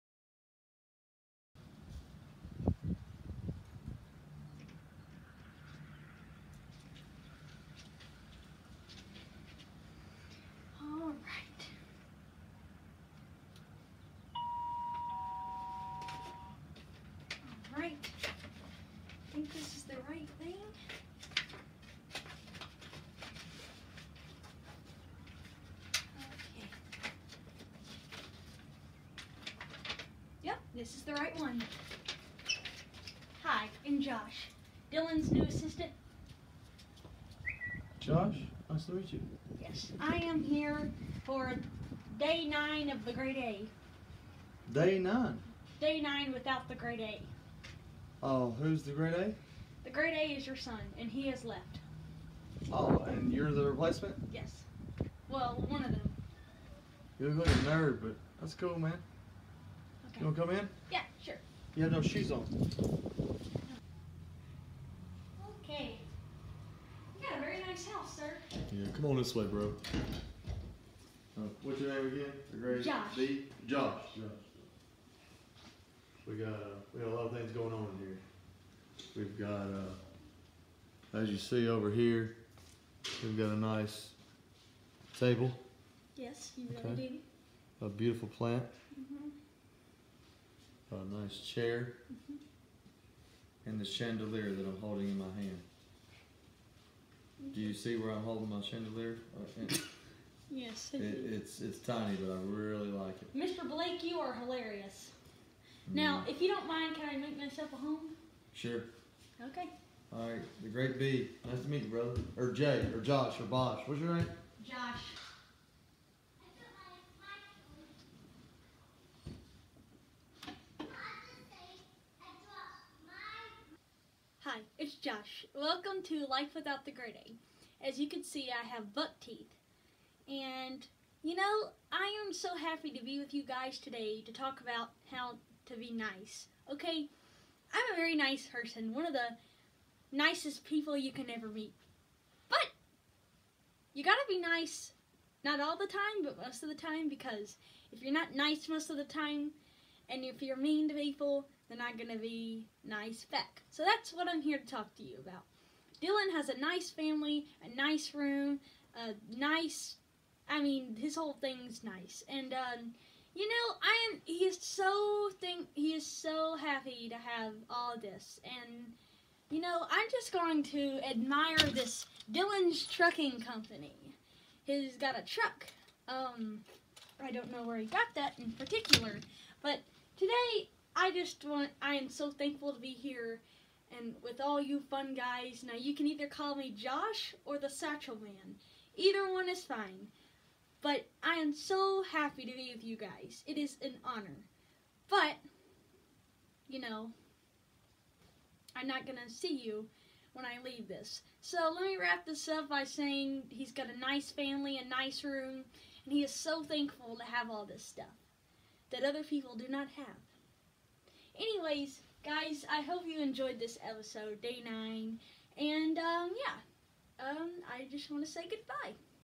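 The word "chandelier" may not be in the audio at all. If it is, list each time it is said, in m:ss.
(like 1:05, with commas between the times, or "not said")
1:33, 1:38.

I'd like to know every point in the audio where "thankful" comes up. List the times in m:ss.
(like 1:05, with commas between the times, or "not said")
3:02, 3:26.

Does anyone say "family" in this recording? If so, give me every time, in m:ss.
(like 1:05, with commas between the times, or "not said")
2:36, 3:24.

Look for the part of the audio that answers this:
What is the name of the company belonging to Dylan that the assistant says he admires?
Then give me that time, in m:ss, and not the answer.
2:52.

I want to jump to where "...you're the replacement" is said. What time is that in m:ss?
0:53.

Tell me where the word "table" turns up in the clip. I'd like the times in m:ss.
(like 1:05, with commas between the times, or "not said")
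1:25.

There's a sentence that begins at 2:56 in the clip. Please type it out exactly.
Um, I don't know where he got that in particular.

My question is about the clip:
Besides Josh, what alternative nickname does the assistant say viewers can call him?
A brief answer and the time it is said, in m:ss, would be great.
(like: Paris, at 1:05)
the Satchel Man, at 3:07.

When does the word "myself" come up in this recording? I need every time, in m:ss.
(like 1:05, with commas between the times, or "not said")
1:47.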